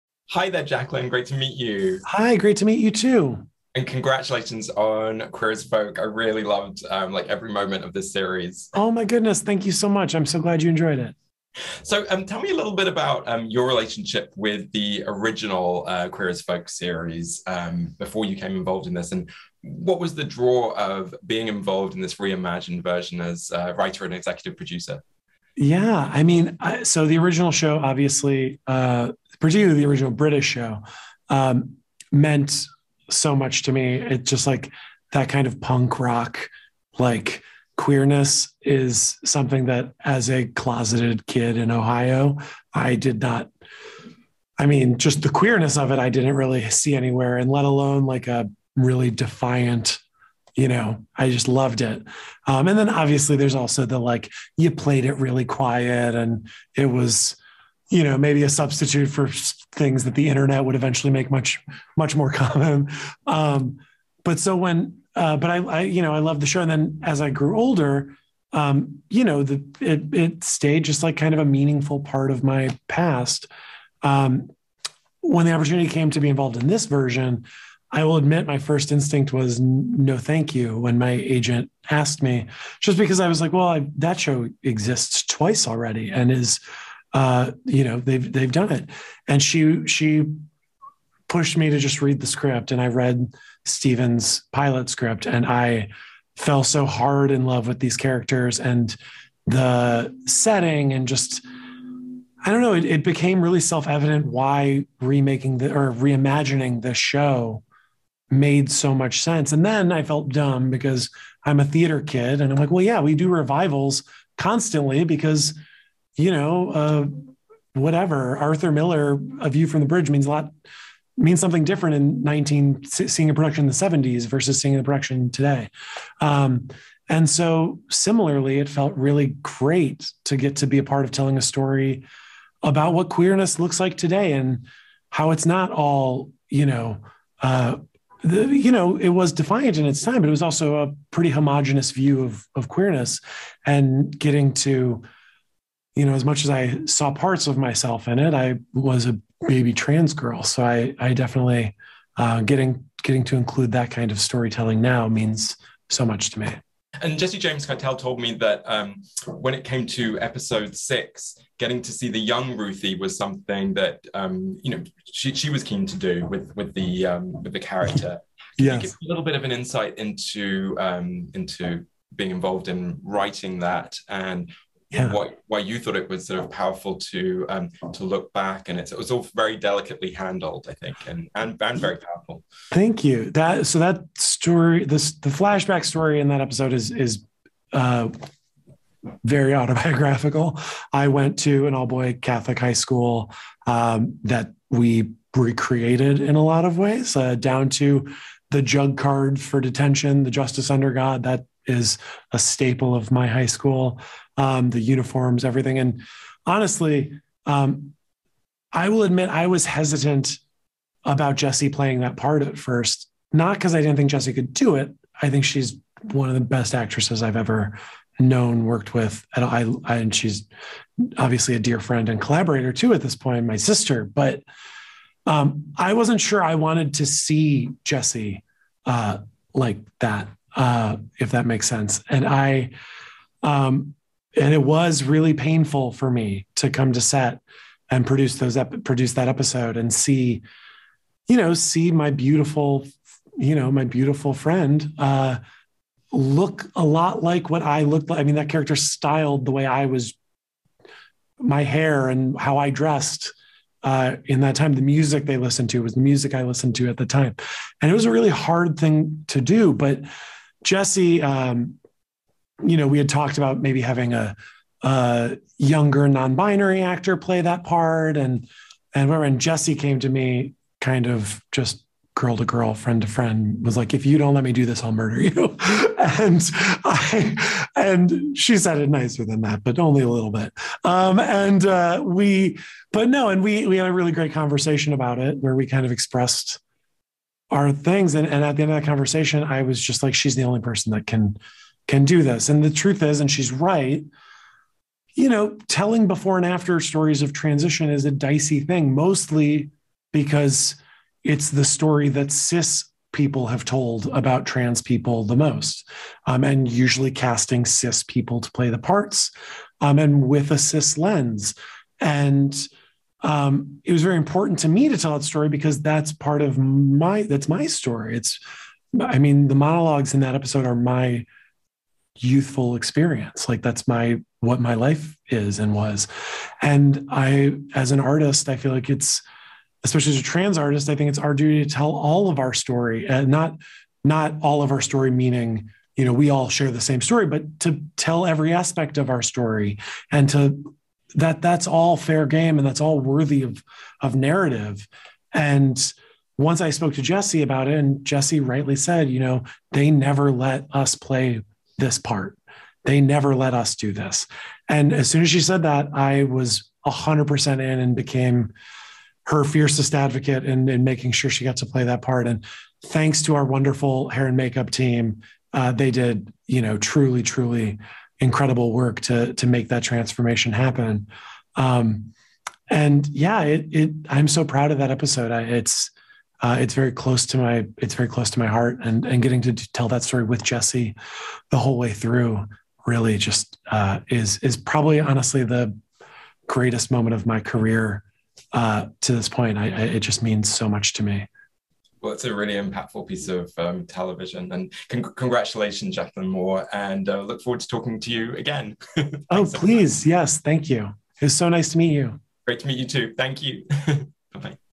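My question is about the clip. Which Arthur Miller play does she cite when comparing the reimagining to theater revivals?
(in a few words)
A View from the Bridge.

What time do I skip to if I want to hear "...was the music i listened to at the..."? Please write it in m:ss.
4:15.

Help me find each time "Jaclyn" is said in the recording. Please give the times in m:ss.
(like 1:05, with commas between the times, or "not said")
0:00, 6:35.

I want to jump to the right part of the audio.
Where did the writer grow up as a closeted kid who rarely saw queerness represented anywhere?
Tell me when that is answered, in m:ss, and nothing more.
0:41.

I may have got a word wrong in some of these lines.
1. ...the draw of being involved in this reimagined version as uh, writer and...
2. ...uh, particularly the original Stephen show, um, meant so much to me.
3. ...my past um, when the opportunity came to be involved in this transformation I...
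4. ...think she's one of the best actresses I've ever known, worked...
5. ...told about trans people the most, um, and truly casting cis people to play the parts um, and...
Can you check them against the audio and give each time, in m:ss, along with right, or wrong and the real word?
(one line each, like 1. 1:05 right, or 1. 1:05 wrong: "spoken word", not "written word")
1. 0:20 right
2. 0:28 wrong: "British", not "Stephen"
3. 1:12 wrong: "version", not "transformation"
4. 3:35 right
5. 5:03 wrong: "usually", not "truly".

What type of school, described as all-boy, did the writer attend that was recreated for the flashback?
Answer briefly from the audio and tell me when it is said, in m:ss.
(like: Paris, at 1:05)
Catholic high school, at 3:12.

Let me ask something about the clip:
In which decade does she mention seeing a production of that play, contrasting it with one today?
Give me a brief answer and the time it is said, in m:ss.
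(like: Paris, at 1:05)
1970s, at 2:03.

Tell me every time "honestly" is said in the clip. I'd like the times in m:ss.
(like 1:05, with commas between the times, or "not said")
3:26, 6:24.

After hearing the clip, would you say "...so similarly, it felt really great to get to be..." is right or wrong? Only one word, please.
right.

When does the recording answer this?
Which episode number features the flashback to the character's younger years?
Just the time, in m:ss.
2:40.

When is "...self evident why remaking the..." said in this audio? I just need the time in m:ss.
1:43.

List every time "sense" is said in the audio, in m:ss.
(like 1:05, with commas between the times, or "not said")
1:49, 3:51.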